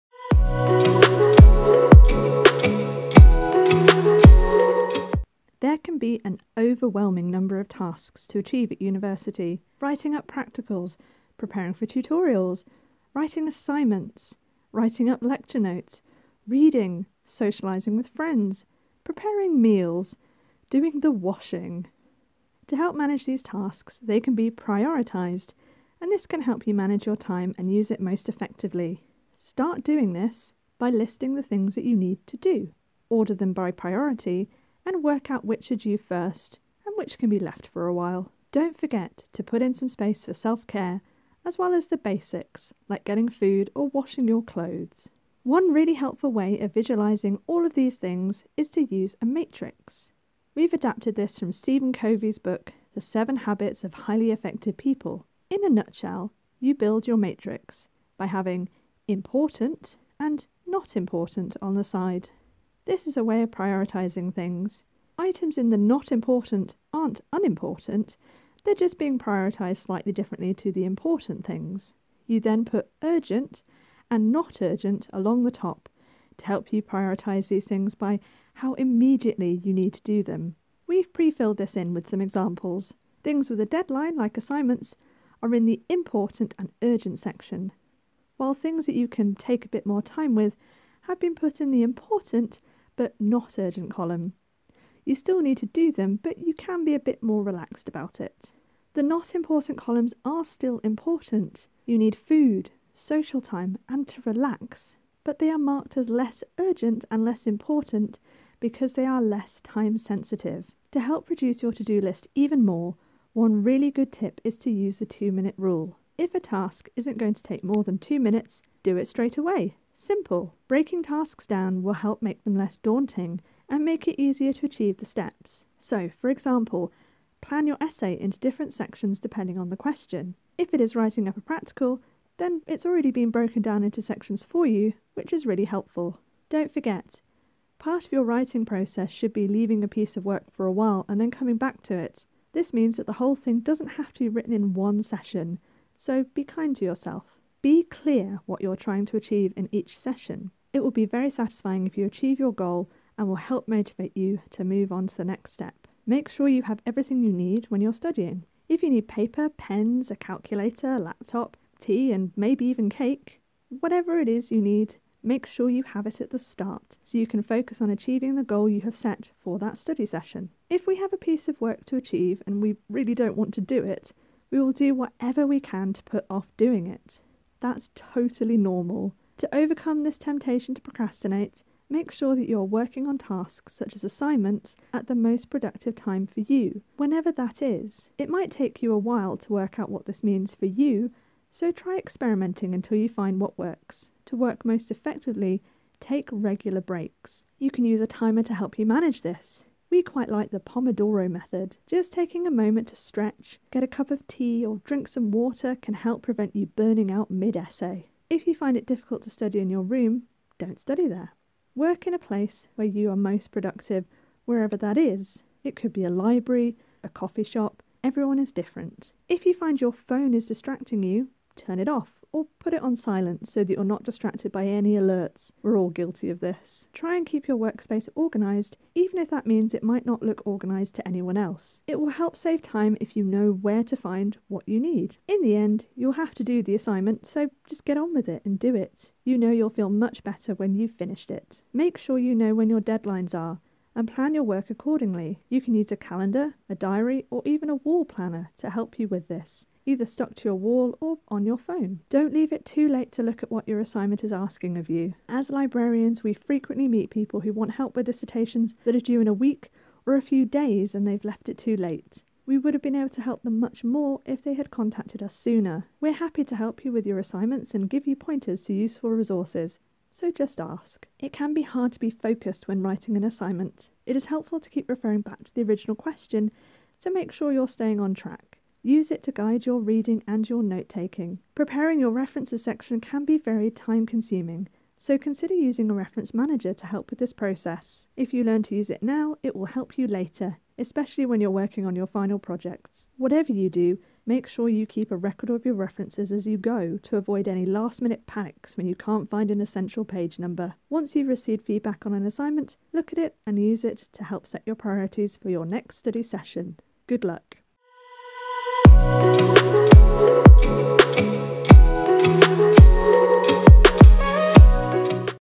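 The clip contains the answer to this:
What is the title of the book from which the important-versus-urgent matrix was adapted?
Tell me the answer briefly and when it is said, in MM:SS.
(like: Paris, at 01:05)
The Seven Habits of Highly Effective People, at 00:52.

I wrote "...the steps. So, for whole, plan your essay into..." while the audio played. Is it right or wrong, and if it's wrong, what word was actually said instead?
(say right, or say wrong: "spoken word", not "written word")
wrong: "example", not "whole".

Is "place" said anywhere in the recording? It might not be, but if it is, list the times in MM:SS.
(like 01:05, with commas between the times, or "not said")
03:32.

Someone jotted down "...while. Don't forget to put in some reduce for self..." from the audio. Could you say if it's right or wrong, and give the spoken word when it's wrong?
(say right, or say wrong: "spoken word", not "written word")
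wrong: "space", not "reduce".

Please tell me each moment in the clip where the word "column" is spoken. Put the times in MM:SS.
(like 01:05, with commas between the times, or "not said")
01:33, 01:39.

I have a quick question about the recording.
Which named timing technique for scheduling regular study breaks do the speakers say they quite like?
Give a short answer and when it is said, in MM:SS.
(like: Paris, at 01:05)
Pomodoro method, at 03:20.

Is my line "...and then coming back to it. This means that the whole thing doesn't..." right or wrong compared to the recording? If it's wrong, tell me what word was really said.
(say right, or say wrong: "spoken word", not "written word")
right.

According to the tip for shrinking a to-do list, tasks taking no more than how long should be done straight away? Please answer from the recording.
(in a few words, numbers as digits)
2 minutes.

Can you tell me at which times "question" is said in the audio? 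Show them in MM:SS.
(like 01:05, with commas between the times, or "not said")
02:09, 04:35.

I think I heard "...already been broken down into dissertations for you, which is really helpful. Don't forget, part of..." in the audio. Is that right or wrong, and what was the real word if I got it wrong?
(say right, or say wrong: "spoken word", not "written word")
wrong: "sections", not "dissertations".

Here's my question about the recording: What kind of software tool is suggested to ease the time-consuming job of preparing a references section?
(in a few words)
reference manager.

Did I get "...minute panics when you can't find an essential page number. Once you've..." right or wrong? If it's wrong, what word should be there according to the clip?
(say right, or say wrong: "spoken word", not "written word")
right.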